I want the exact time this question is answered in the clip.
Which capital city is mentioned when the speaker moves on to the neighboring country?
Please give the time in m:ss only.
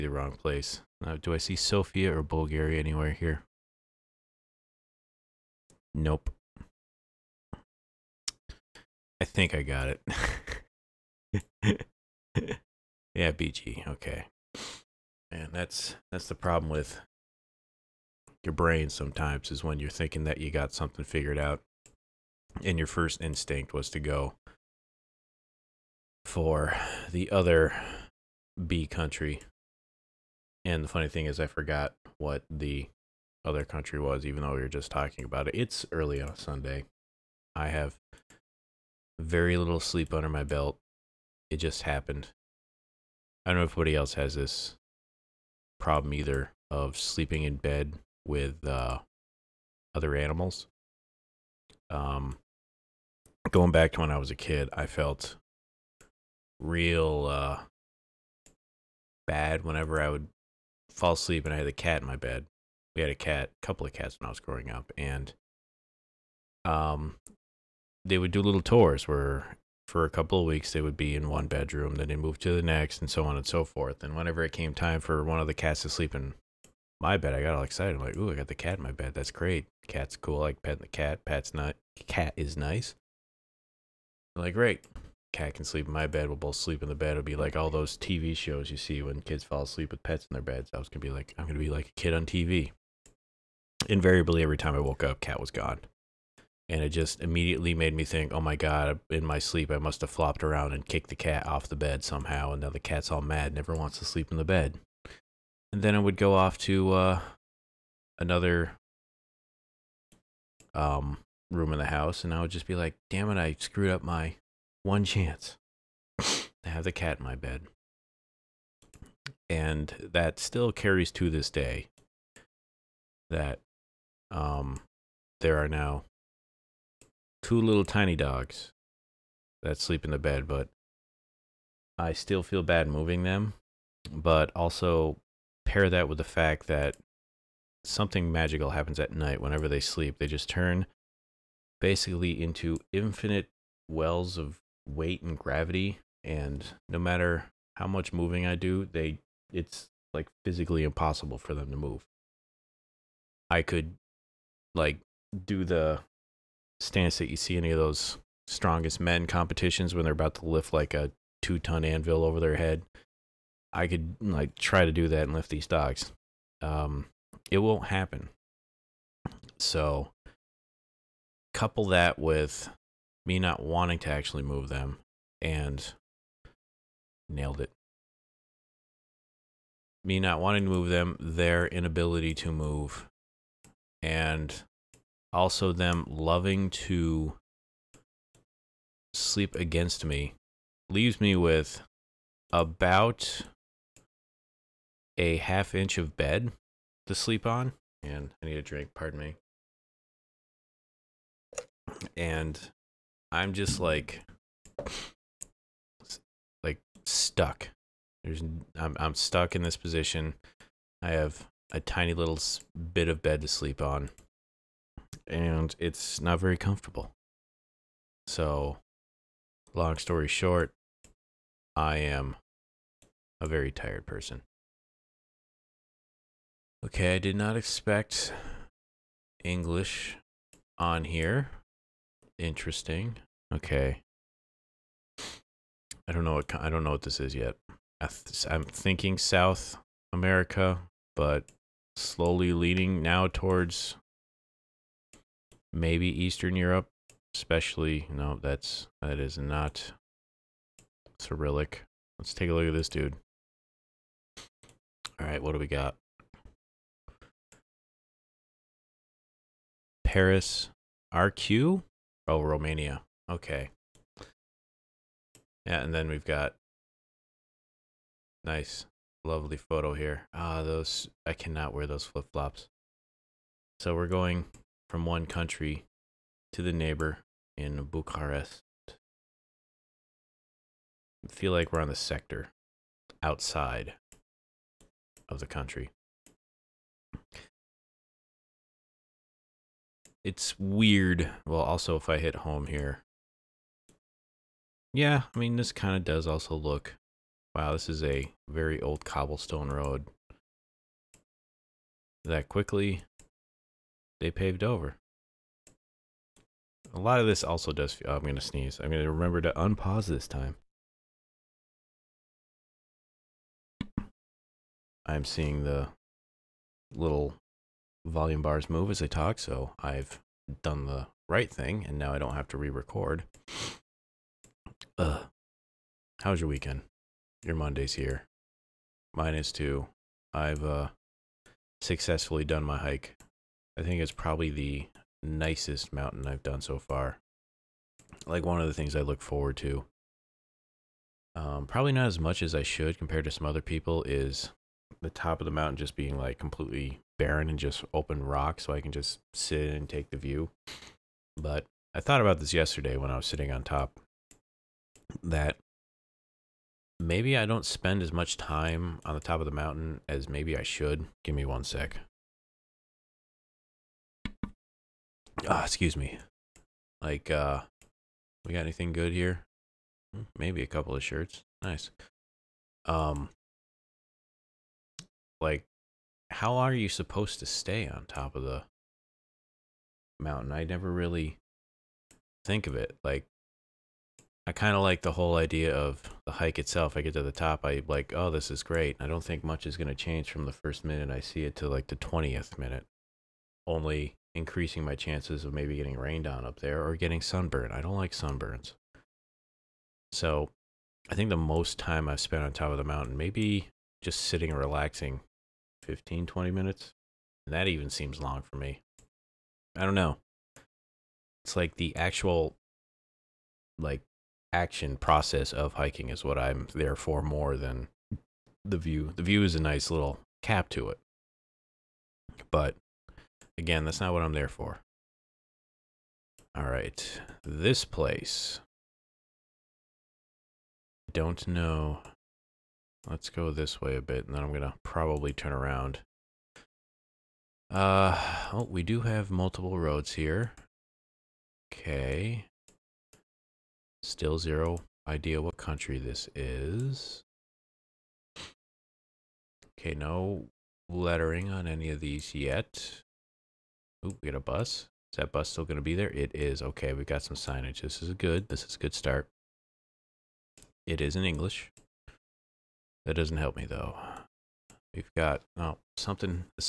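4:37.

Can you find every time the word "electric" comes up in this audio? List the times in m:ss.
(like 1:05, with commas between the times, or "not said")
not said.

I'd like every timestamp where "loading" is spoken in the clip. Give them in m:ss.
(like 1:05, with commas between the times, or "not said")
not said.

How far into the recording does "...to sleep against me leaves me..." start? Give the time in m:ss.
3:06.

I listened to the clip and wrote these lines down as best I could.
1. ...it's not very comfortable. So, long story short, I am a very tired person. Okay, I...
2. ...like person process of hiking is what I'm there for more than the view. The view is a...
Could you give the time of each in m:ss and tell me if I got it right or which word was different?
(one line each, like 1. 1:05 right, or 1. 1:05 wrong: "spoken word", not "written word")
1. 3:35 right
2. 6:53 wrong: "action", not "person".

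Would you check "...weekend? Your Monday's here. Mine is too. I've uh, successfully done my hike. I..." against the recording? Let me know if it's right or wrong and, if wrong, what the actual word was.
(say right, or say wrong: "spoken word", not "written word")
right.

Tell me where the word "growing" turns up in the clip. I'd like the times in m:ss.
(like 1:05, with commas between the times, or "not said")
1:04.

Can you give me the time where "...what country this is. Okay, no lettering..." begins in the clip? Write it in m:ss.
7:25.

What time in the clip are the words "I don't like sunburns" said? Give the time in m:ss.
6:37.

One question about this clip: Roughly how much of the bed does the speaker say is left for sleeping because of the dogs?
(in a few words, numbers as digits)
half inch.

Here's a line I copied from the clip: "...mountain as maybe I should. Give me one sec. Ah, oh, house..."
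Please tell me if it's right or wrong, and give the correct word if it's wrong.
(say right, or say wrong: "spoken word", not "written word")
wrong: "excuse", not "house".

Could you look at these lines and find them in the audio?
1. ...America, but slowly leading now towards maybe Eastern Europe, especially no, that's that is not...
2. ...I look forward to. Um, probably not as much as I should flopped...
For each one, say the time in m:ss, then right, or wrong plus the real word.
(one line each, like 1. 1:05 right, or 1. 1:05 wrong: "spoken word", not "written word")
1. 4:00 right
2. 5:38 wrong: "compared", not "flopped".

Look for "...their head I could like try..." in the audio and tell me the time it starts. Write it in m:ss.
2:42.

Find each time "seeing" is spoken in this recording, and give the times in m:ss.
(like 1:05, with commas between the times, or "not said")
5:15.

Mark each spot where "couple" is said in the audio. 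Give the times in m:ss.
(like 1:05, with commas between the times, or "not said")
1:03, 1:10, 2:51, 6:10.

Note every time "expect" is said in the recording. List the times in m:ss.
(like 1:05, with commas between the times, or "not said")
3:47.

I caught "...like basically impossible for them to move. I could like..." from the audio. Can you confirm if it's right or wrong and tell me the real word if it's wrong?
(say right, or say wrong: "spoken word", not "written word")
wrong: "physically", not "basically".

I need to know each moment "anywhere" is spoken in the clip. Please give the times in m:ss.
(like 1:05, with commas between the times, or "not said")
0:02.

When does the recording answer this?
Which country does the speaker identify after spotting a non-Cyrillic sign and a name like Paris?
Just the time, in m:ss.
4:22.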